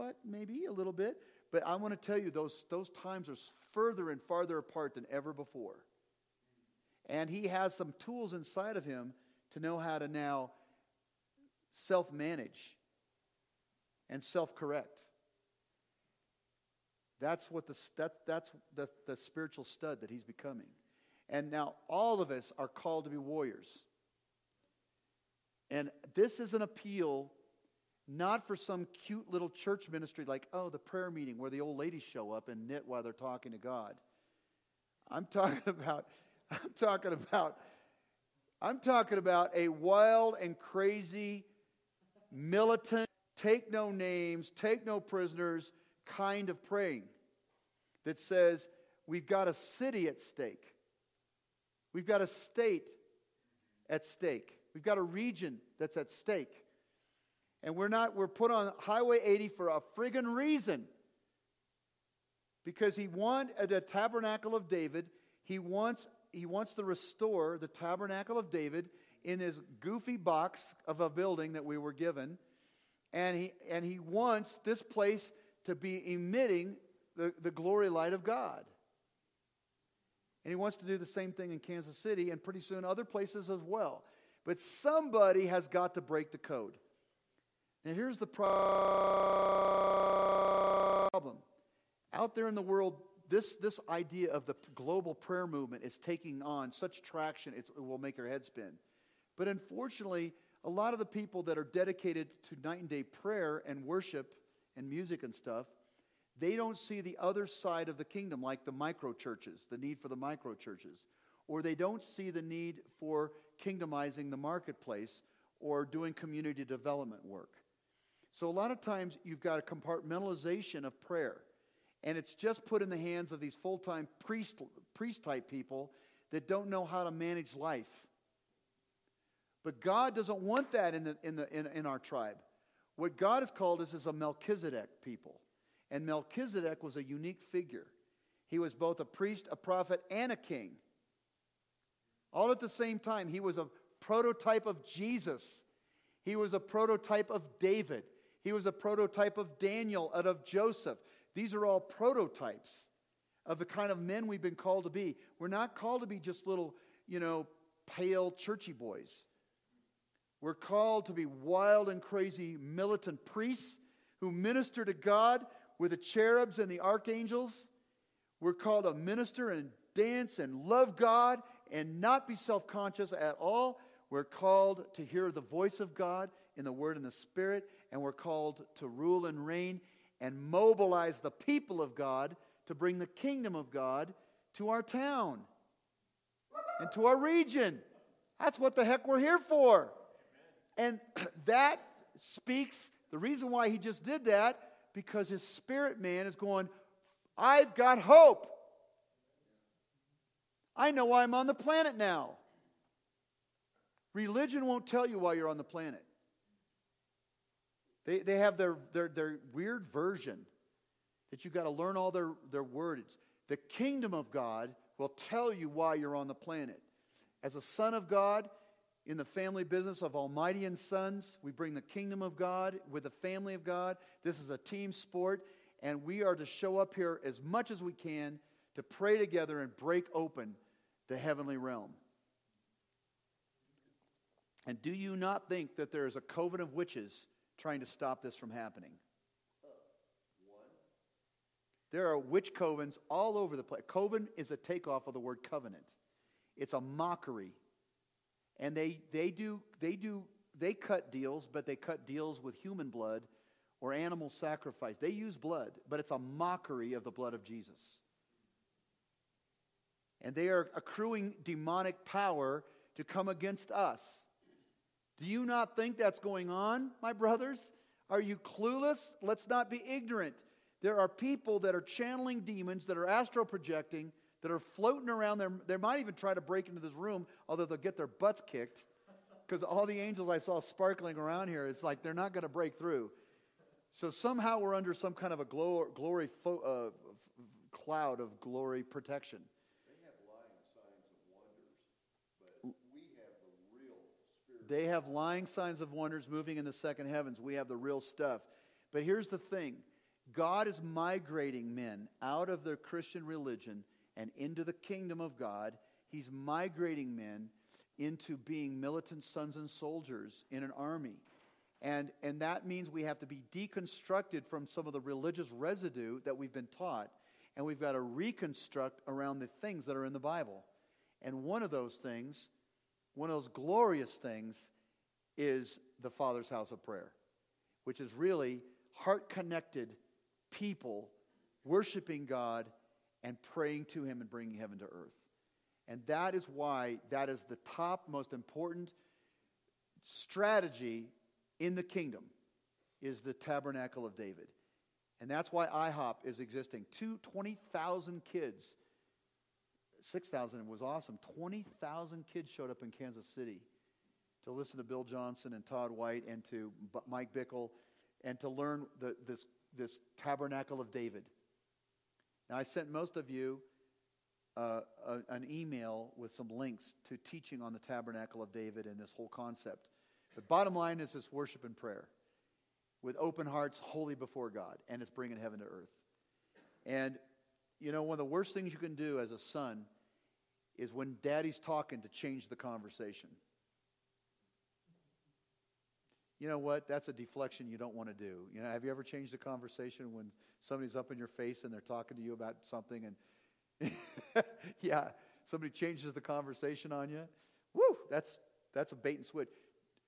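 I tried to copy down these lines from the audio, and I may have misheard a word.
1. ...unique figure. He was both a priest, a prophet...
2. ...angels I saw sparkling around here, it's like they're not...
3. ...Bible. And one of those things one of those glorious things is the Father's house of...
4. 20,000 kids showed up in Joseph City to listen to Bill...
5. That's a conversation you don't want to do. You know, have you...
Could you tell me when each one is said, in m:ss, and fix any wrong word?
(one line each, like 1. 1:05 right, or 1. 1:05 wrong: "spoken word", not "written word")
1. 2:17 right
2. 4:40 right
3. 5:20 right
4. 5:51 wrong: "Kansas", not "Joseph"
5. 6:26 wrong: "deflection", not "conversation".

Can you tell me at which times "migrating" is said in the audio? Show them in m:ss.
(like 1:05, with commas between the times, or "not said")
5:00, 5:06.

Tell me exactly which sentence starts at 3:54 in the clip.
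And do you not think that there is a coven of witches trying to stop this from happening.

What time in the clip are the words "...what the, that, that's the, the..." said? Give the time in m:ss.
0:17.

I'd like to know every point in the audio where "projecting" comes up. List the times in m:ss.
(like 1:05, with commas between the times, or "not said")
4:33.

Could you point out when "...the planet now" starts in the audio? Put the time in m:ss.
3:21.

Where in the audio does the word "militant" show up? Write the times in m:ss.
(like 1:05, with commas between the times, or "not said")
0:42, 2:42, 5:08.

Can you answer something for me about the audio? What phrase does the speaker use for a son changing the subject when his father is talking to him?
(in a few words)
Bait and switch.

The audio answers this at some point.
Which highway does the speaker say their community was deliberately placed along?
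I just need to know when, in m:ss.
0:58.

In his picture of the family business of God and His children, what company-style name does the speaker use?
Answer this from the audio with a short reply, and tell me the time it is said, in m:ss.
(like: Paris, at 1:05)
Almighty and Sons, at 3:40.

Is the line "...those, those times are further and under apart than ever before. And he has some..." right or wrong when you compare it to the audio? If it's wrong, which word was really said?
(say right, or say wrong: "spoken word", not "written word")
wrong: "farther", not "under".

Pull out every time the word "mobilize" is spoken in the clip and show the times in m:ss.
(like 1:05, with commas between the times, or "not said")
3:00.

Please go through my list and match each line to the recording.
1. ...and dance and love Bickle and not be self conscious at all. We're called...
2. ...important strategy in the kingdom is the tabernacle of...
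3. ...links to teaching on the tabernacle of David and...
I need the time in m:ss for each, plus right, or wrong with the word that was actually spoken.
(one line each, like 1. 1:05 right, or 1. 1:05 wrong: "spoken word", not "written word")
1. 2:49 wrong: "God", not "Bickle"
2. 5:38 right
3. 6:06 right.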